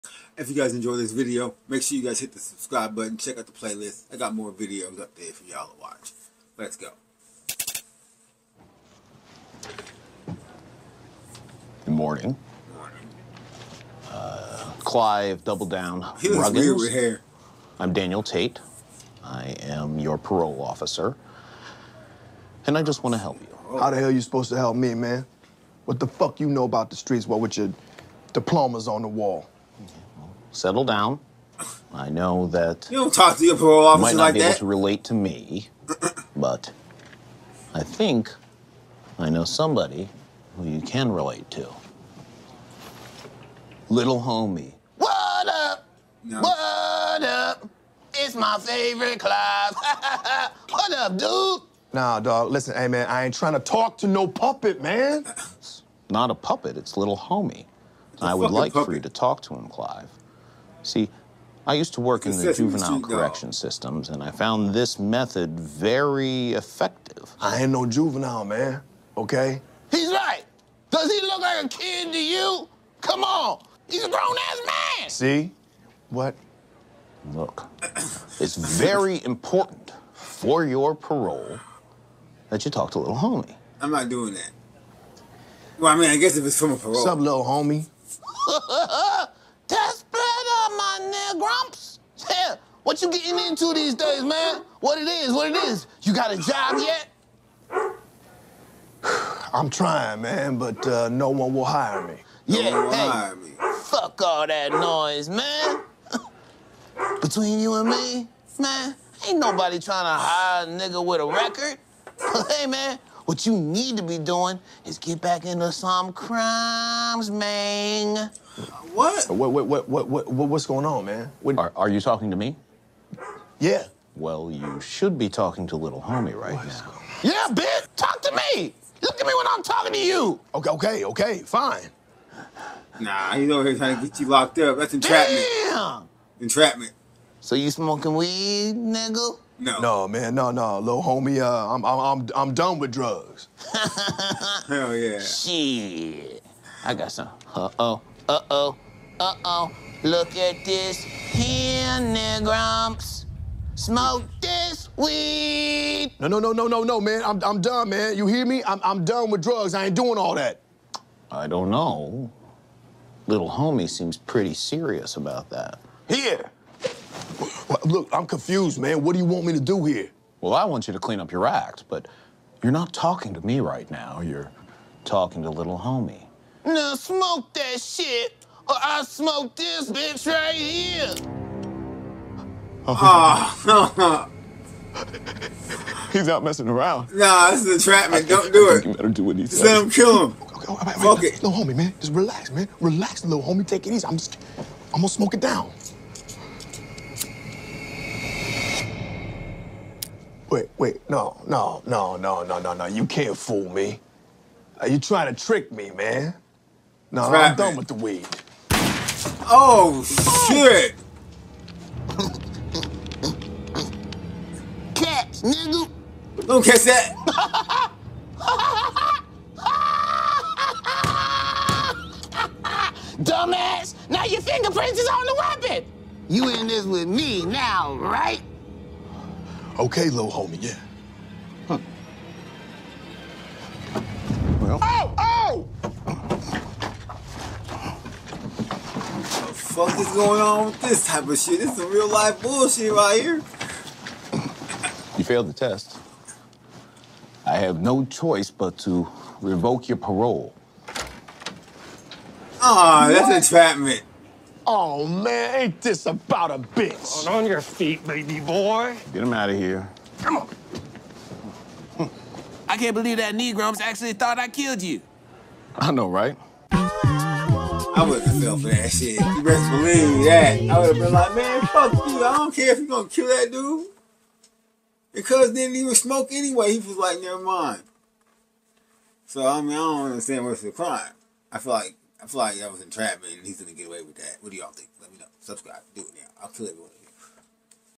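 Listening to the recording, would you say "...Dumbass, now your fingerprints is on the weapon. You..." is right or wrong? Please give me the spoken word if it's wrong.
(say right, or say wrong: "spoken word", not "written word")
right.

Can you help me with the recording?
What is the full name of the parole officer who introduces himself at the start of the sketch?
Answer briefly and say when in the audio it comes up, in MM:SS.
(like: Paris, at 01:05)
Daniel Tate, at 00:17.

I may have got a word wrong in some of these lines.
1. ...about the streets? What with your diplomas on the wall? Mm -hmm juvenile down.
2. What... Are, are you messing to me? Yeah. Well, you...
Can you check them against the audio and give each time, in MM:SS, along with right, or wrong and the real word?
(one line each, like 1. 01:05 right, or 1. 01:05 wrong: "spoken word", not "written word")
1. 00:26 wrong: "settle", not "juvenile"
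2. 02:01 wrong: "talking", not "messing".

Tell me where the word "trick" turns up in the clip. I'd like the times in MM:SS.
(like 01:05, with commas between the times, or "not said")
03:25.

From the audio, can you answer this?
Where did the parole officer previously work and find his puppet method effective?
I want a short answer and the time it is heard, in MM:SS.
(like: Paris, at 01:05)
juvenile correction systems, at 01:02.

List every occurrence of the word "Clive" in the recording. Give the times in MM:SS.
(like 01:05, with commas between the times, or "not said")
00:14, 00:59.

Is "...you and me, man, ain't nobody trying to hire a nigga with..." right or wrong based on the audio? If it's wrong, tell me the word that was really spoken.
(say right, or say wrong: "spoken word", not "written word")
right.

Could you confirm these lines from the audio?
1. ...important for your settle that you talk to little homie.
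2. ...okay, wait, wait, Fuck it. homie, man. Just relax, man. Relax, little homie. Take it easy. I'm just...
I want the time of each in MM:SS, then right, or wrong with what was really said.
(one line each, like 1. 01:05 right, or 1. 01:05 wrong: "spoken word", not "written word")
1. 01:19 wrong: "parole", not "settle"
2. 03:10 right.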